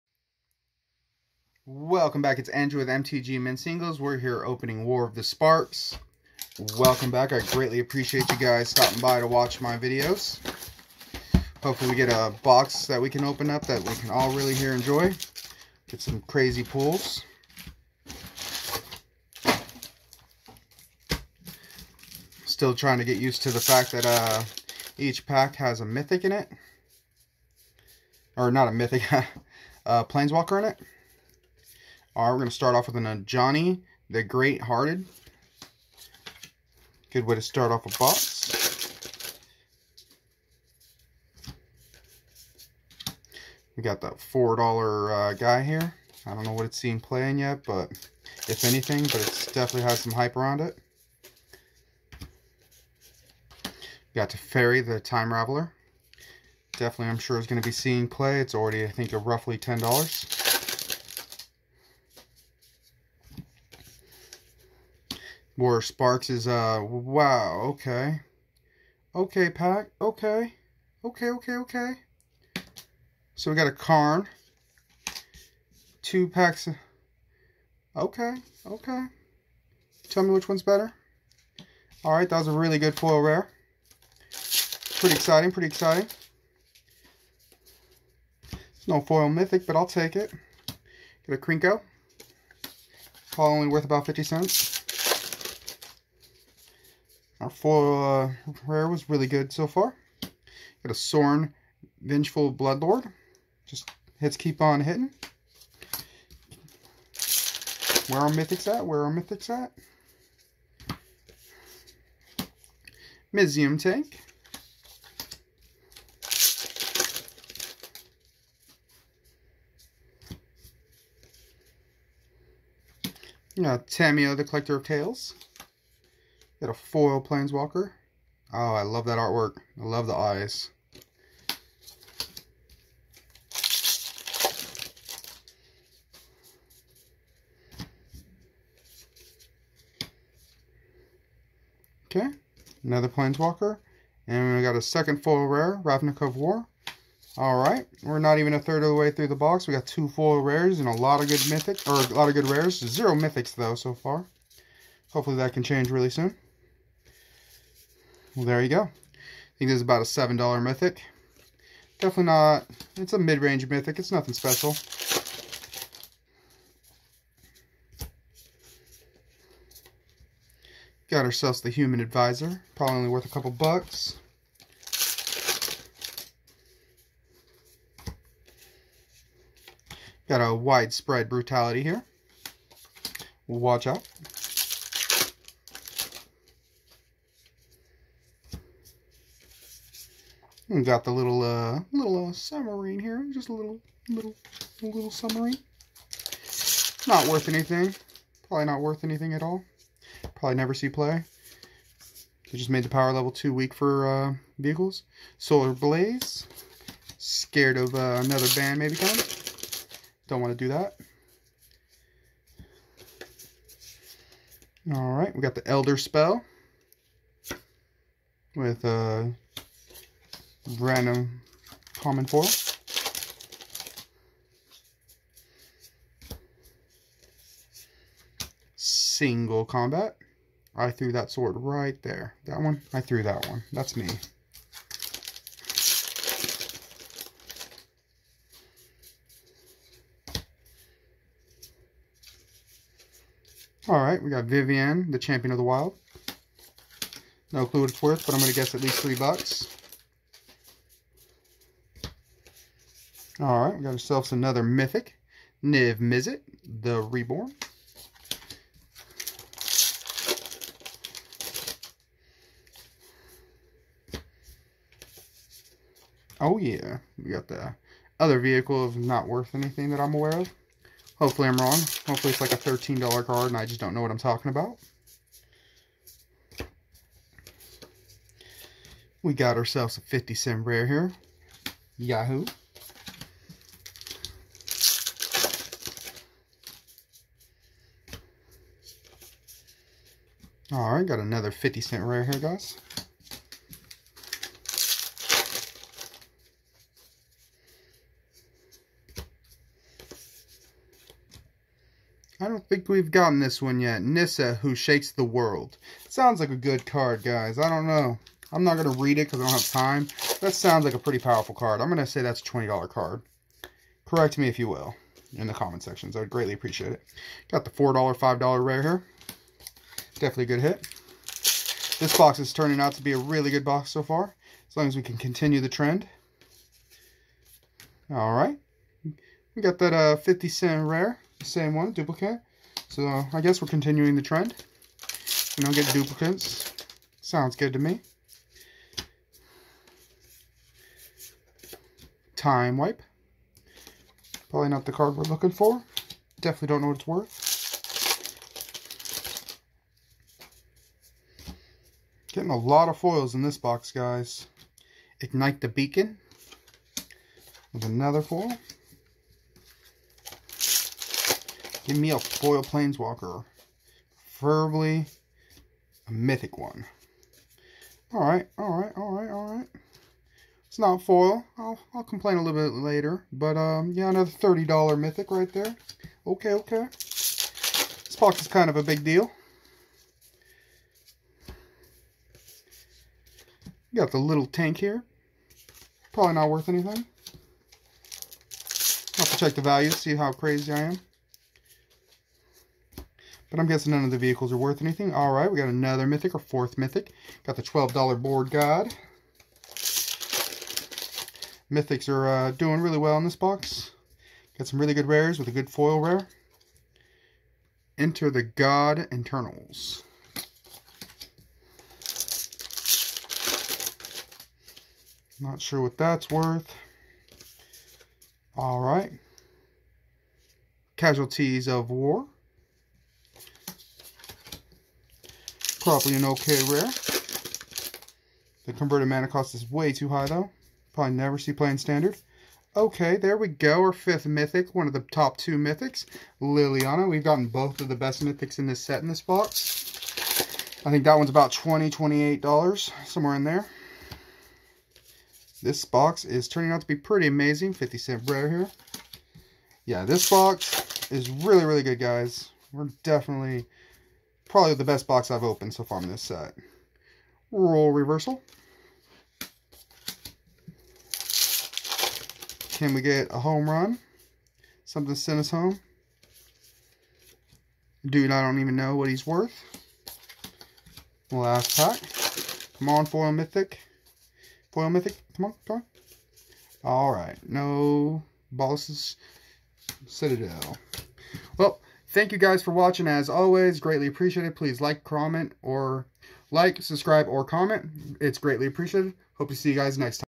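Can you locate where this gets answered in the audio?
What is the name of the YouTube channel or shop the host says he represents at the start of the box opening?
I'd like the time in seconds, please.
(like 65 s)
2 s.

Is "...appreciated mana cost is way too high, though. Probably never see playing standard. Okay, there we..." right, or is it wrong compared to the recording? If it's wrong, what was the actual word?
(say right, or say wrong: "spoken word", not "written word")
wrong: "converted", not "appreciated".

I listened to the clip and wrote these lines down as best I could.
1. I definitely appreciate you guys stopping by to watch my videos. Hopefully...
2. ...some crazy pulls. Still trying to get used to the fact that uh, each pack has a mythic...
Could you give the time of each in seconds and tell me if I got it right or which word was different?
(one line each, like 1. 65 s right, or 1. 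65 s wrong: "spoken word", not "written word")
1. 7 s wrong: "greatly", not "definitely"
2. 16 s right.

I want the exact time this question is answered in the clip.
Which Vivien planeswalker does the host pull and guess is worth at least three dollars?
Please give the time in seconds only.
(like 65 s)
244 s.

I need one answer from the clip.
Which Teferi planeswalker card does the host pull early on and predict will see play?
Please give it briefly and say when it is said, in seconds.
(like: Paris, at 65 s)
Teferi the Time Raveler, at 54 s.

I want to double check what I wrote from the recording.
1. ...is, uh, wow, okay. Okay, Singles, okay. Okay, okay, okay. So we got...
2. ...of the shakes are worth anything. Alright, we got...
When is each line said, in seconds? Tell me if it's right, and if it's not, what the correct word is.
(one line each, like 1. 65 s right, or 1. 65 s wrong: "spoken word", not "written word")
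1. 66 s wrong: "Pack", not "Singles"
2. 394 s wrong: "vehicles", not "shakes".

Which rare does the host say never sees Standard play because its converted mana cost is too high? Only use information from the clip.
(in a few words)
Casualties of War.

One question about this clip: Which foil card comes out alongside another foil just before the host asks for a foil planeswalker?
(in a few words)
Ignite the Beacon.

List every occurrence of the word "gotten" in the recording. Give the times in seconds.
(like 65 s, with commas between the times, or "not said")
303 s, 437 s.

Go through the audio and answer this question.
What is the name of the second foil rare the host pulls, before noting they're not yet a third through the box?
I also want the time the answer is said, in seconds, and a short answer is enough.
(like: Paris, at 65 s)
Ravnica at War, at 145 s.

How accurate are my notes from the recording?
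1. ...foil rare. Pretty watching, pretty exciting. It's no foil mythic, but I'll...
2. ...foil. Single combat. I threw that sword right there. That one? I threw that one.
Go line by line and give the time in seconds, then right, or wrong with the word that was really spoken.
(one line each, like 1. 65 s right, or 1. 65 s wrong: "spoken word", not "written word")
1. 82 s wrong: "exciting", not "watching"
2. 222 s right.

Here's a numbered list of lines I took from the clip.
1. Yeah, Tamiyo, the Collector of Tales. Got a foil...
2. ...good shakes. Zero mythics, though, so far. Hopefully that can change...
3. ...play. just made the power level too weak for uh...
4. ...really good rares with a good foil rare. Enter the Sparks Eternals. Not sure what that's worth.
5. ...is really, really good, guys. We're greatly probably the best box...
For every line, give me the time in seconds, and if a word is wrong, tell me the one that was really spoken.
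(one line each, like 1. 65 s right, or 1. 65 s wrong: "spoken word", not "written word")
1. 123 s right
2. 152 s wrong: "rares", not "shakes"
3. 200 s right
4. 404 s wrong: "God", not "Sparks"
5. 451 s wrong: "definitely", not "greatly".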